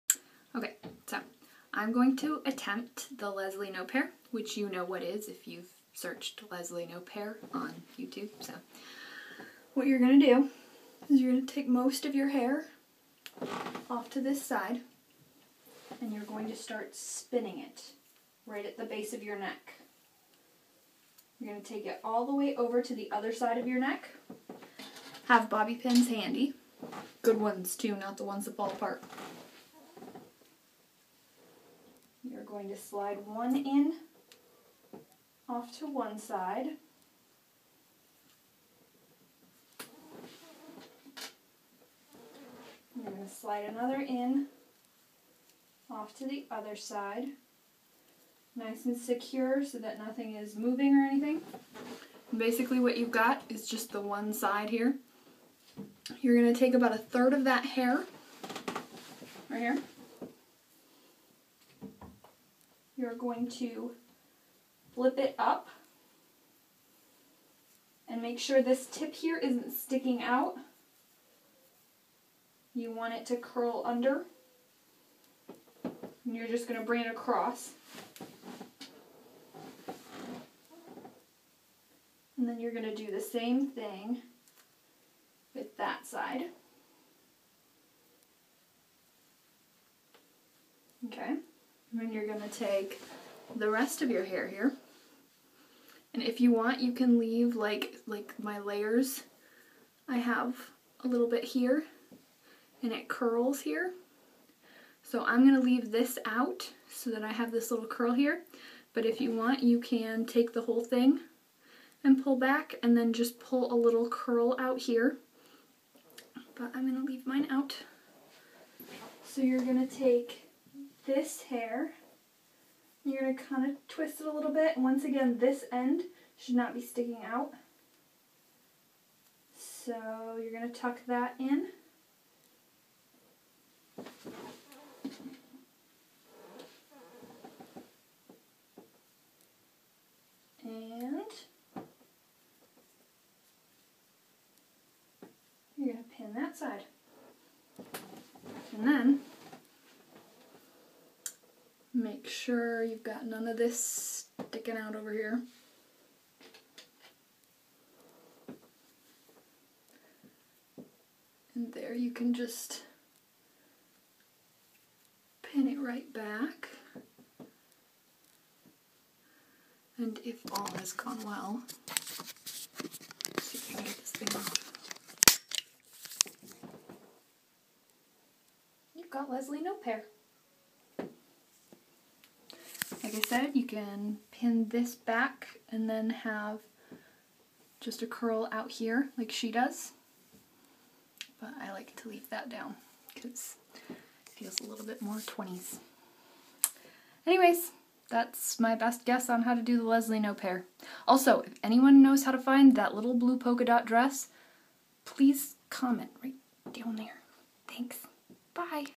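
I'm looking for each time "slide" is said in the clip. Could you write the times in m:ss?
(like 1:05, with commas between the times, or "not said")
0:32, 0:43.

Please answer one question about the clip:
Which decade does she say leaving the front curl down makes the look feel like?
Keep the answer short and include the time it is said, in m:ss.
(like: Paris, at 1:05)
20s, at 3:15.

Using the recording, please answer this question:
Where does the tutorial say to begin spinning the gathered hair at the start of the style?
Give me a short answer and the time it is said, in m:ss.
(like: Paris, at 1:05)
Base of your neck, at 0:18.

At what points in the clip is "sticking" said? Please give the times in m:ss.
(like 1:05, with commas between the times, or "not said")
1:09, 2:06, 2:34.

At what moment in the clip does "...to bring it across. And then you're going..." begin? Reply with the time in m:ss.
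1:16.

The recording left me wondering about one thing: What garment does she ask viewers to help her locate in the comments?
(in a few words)
Blue polka dot dress.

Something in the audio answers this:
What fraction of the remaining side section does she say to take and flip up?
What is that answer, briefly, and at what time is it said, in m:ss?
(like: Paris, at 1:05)
A third, at 0:56.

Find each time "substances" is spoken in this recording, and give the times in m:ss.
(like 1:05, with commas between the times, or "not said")
not said.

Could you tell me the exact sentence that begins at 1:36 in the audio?
And if you want, you can leave like, like my layers.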